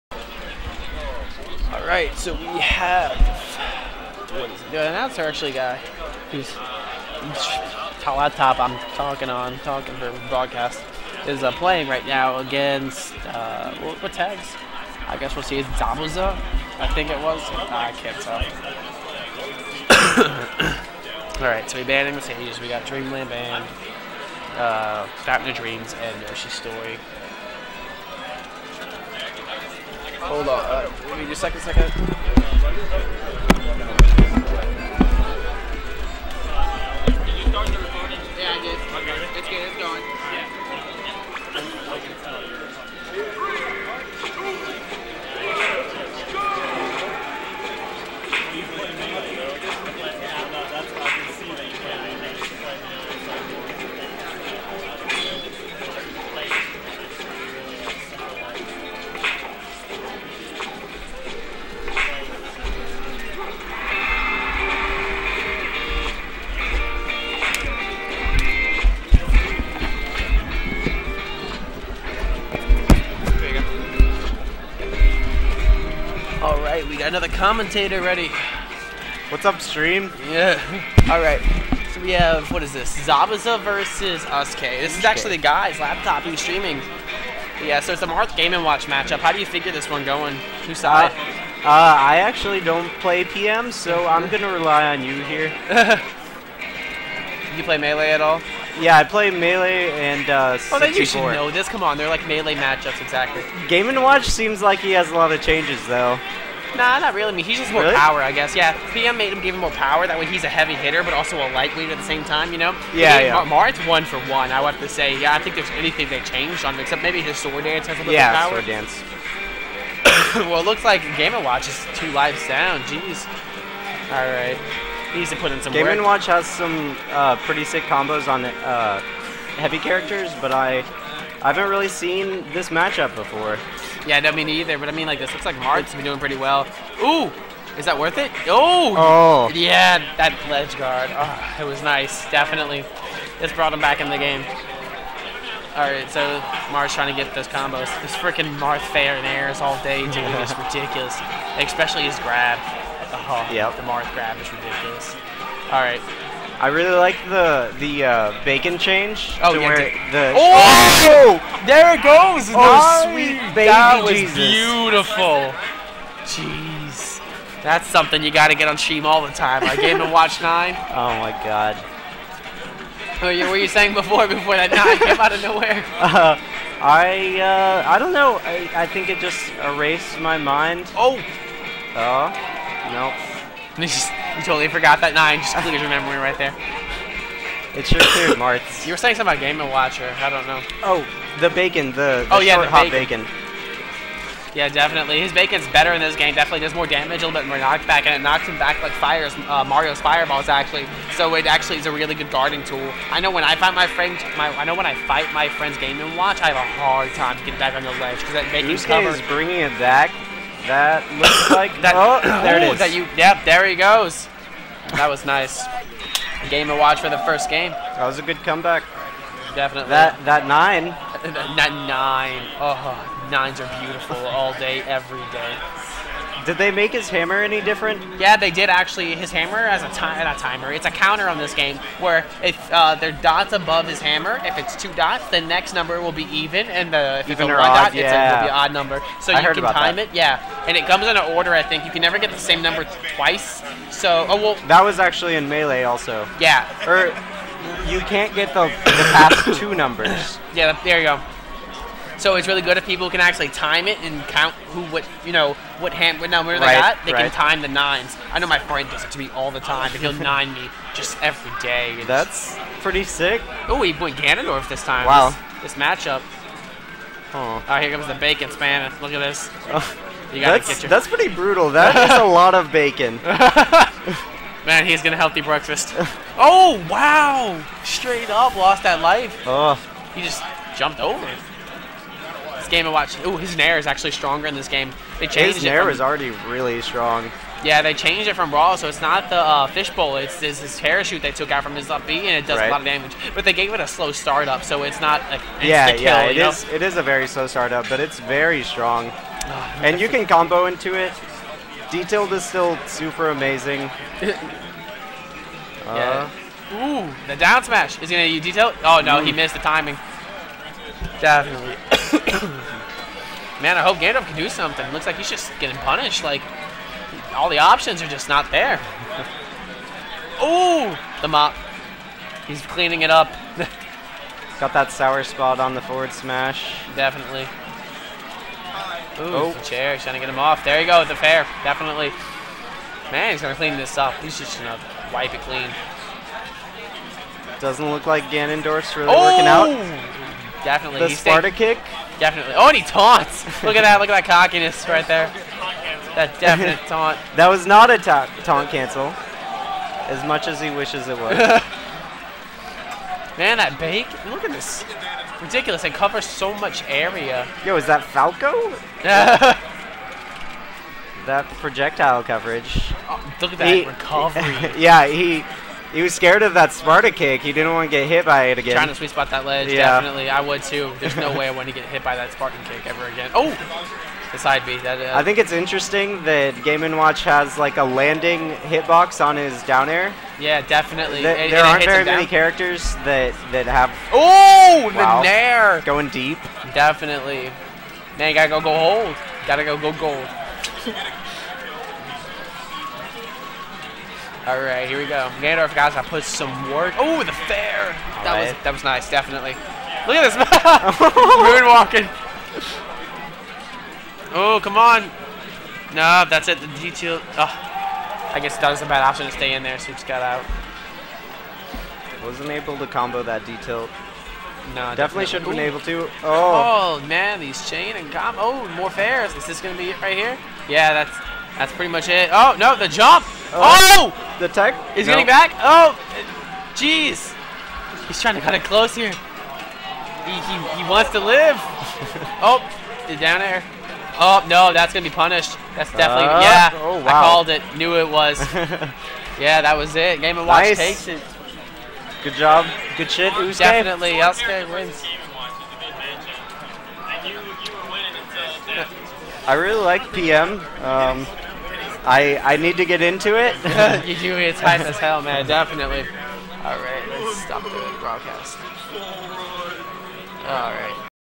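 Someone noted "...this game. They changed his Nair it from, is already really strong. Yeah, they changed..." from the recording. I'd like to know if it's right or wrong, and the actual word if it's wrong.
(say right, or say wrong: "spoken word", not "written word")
right.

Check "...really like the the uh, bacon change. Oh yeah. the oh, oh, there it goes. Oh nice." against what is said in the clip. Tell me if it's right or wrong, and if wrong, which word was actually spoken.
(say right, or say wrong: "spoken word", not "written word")
right.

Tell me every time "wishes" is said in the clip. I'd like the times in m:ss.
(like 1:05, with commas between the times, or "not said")
5:50.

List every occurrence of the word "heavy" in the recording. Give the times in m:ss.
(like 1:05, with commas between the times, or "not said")
1:50, 2:09.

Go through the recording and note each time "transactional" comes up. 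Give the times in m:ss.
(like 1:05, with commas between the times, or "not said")
not said.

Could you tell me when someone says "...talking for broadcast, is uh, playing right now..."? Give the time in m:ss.
0:09.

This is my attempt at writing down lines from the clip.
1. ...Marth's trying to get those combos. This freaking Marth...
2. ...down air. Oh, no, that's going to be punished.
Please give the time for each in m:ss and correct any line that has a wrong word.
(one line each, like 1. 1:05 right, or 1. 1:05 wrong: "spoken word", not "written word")
1. 2:26 right
2. 7:13 right.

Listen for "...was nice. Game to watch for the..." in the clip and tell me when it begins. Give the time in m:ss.
3:35.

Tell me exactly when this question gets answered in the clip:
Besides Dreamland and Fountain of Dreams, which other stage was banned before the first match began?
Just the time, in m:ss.
0:26.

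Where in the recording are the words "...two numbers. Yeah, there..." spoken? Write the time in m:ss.
4:09.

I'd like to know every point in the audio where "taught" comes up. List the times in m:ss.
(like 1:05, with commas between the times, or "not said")
not said.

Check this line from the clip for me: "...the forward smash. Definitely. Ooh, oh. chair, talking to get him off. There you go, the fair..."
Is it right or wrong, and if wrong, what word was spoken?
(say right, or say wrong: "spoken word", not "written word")
wrong: "trying", not "talking".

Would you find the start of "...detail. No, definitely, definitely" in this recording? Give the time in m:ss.
6:53.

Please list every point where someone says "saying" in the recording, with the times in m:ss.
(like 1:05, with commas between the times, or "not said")
2:53, 3:08.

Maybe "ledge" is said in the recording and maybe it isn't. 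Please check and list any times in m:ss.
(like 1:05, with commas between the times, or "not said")
2:20, 3:28, 6:09.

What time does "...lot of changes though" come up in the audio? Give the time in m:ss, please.
1:45.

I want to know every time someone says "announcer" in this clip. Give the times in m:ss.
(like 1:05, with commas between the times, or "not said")
0:04.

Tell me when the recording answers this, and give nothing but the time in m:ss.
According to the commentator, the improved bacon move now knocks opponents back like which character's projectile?
3:19.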